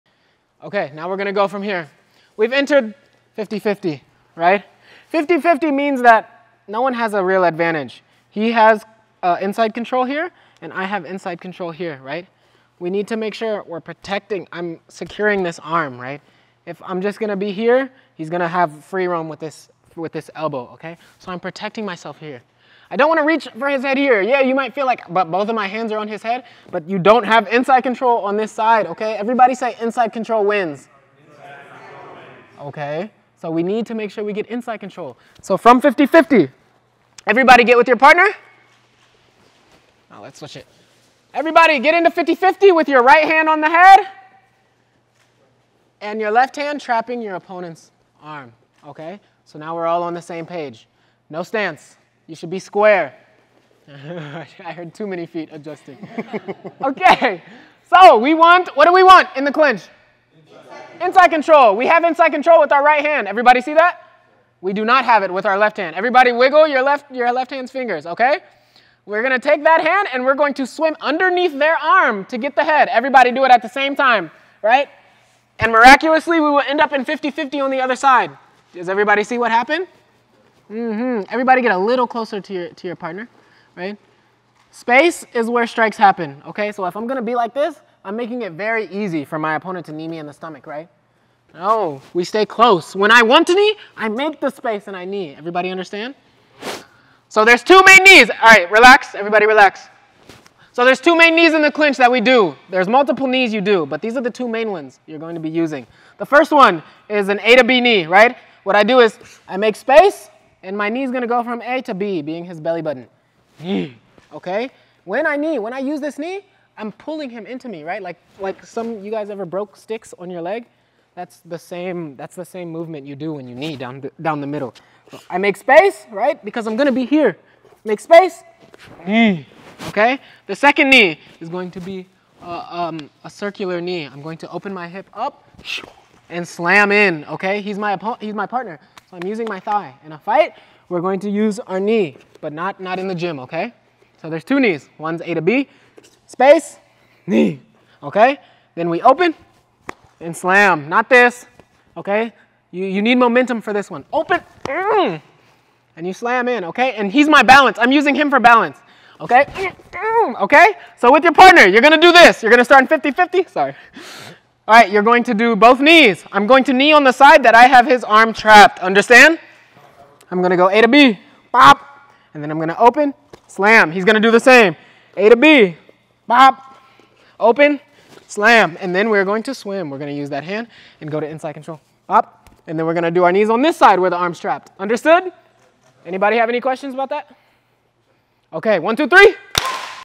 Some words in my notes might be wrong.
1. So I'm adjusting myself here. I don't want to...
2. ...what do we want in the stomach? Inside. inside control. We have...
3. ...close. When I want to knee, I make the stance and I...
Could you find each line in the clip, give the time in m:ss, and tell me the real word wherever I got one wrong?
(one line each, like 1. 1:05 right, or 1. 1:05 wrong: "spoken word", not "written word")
1. 0:21 wrong: "protecting", not "adjusting"
2. 0:58 wrong: "clinch", not "stomach"
3. 1:32 wrong: "space", not "stance".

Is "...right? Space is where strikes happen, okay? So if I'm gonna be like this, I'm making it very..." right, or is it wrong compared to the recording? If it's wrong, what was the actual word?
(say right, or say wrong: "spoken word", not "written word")
right.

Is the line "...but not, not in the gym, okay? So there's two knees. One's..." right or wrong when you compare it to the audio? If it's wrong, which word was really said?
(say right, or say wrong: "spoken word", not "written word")
right.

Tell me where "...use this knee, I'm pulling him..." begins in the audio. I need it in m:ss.
1:55.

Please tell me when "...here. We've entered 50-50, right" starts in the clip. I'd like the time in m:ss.
0:01.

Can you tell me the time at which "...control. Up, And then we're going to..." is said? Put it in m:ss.
3:01.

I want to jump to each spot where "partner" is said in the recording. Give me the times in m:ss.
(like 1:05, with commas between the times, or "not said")
0:37, 1:22, 2:18, 2:41.